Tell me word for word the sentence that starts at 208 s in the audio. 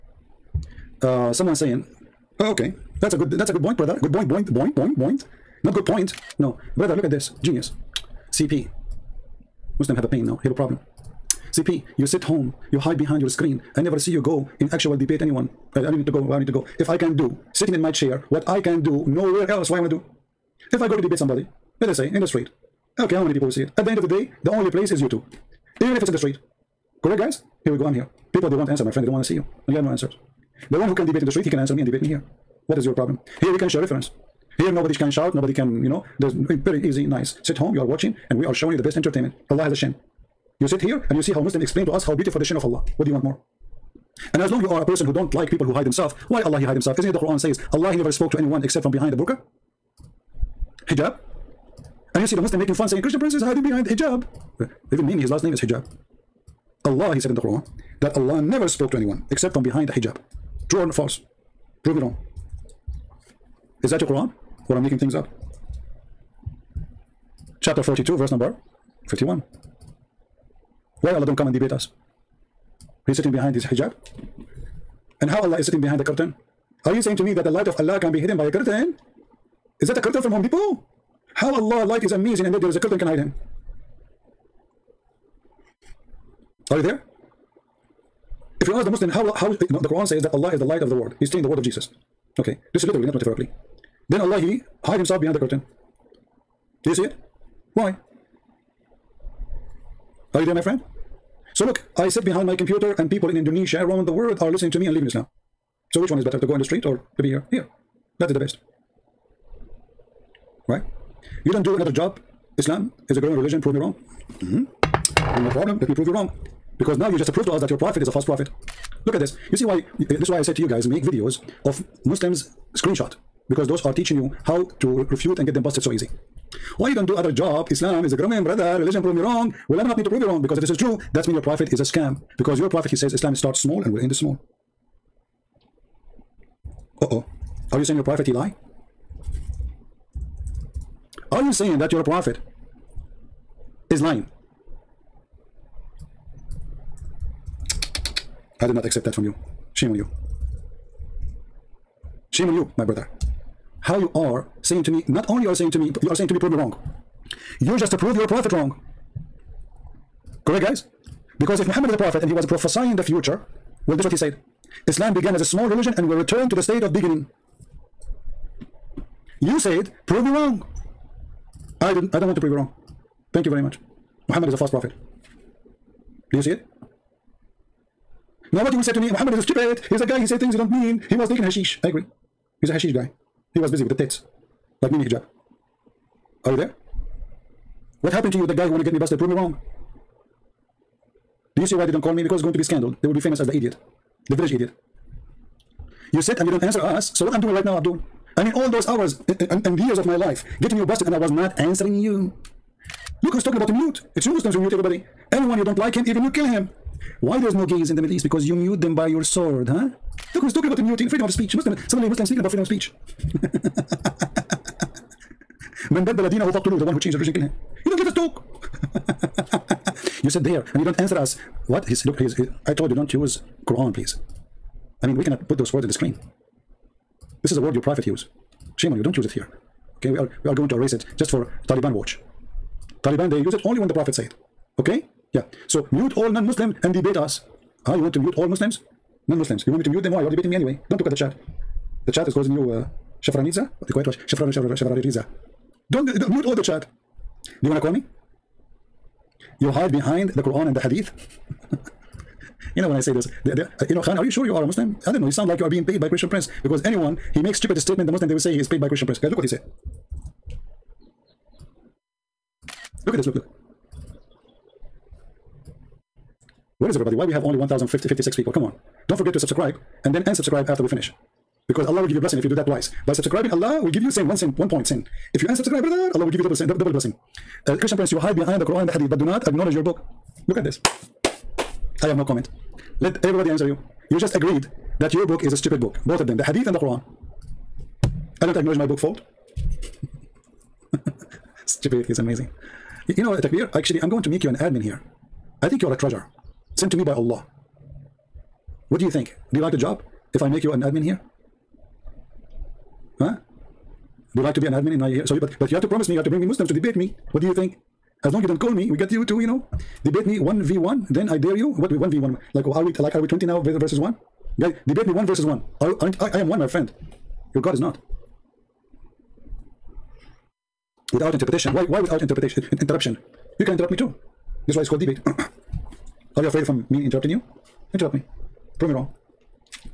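Because you mute them by your sword, huh?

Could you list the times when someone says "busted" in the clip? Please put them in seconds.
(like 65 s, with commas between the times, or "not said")
125 s, 188 s, 200 s.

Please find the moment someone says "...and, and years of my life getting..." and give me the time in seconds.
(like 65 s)
199 s.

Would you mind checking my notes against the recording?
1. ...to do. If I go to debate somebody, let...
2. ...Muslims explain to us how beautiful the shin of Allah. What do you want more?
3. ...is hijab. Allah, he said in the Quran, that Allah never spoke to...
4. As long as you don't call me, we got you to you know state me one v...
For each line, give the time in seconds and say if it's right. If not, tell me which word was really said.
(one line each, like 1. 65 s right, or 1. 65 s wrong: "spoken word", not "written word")
1. 19 s right
2. 41 s right
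3. 55 s right
4. 308 s wrong: "debate", not "state".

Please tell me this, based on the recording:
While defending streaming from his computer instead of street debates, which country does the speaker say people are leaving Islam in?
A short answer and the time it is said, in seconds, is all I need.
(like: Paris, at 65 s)
Indonesia, at 103 s.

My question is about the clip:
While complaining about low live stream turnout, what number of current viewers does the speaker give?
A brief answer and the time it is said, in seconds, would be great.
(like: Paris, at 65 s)
1,056, at 267 s.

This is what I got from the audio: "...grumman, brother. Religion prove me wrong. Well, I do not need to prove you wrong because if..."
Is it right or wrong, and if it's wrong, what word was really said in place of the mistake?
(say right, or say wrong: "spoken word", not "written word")
right.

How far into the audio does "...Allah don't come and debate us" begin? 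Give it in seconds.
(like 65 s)
71 s.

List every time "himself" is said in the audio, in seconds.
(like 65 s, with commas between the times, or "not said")
46 s, 94 s.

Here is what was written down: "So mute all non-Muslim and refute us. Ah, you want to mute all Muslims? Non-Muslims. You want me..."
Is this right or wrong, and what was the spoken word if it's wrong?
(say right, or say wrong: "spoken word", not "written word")
wrong: "debate", not "refute".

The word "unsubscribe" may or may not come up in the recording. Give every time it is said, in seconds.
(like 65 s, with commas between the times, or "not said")
270 s, 275 s.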